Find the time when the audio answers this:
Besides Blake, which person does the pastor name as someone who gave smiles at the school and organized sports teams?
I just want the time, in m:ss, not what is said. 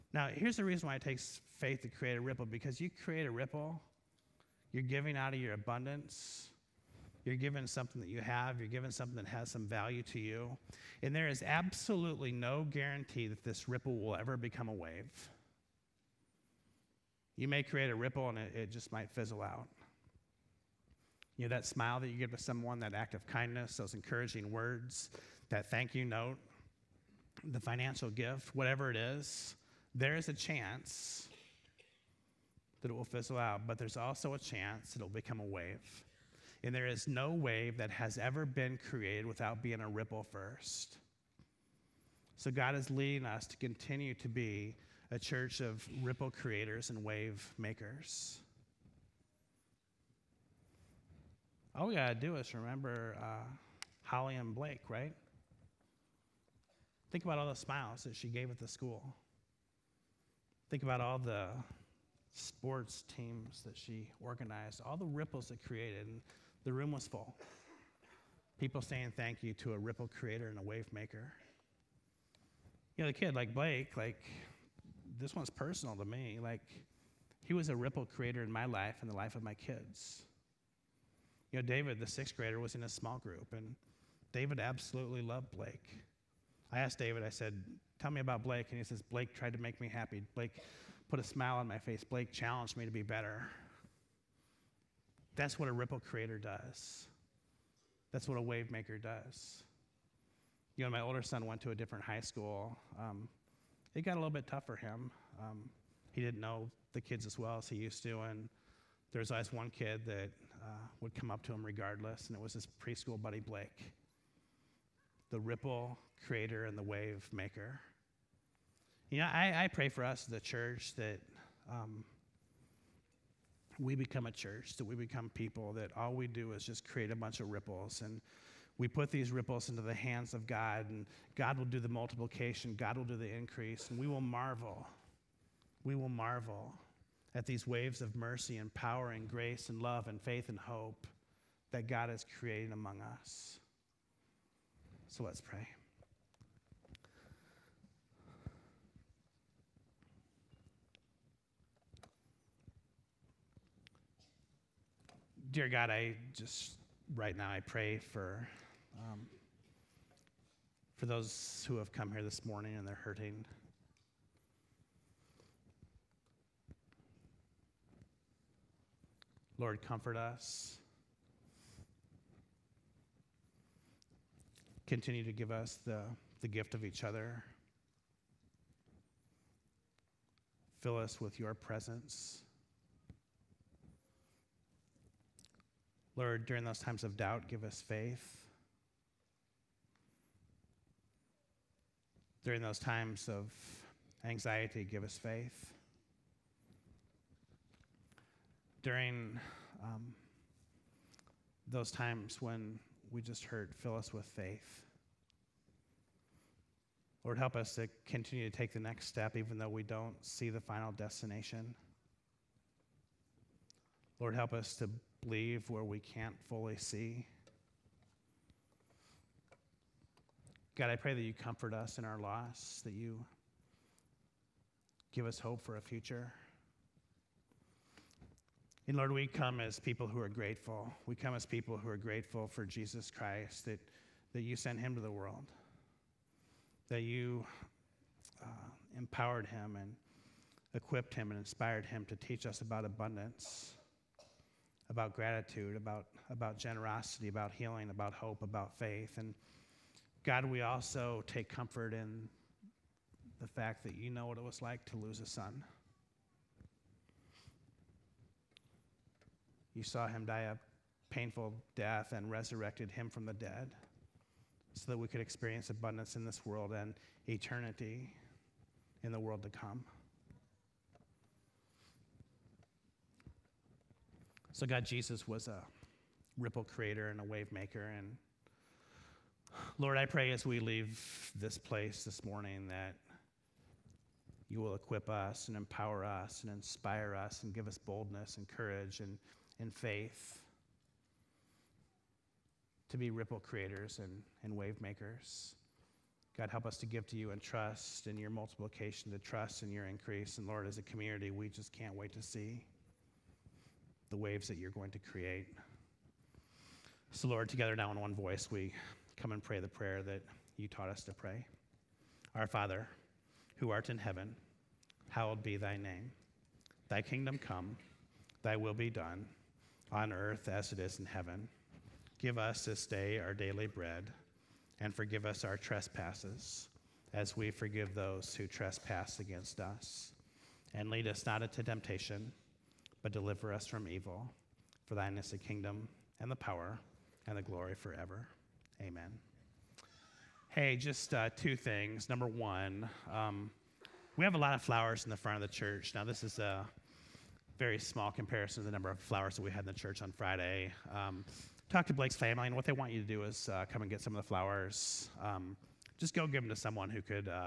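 0:54.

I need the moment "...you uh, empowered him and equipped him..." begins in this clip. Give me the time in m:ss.
3:57.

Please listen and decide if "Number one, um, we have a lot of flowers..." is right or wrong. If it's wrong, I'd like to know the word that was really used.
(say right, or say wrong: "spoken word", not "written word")
right.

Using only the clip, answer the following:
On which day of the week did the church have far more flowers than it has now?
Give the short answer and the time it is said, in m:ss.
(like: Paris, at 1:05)
Friday, at 5:50.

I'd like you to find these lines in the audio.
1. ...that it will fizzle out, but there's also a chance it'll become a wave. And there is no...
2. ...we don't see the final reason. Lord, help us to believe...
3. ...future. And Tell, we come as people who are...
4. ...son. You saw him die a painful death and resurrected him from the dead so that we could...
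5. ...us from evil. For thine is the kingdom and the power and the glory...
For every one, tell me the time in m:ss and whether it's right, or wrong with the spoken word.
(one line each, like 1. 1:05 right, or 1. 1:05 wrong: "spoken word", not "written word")
1. 0:32 right
2. 3:29 wrong: "destination", not "reason"
3. 3:45 wrong: "Lord", not "Tell"
4. 4:15 right
5. 5:33 right.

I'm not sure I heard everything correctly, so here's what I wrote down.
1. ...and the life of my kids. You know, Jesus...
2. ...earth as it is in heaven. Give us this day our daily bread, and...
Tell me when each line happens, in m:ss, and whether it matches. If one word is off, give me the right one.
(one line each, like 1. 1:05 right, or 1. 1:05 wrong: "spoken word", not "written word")
1. 1:19 wrong: "David", not "Jesus"
2. 5:20 right.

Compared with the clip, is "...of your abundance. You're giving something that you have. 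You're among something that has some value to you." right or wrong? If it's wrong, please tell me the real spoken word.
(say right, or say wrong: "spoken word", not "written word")
wrong: "giving", not "among".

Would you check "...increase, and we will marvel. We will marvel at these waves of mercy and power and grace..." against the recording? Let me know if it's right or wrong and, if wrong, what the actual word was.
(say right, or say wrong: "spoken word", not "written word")
right.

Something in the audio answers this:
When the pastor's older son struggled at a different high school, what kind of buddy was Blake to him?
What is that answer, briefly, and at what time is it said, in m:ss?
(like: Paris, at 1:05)
preschool buddy, at 1:52.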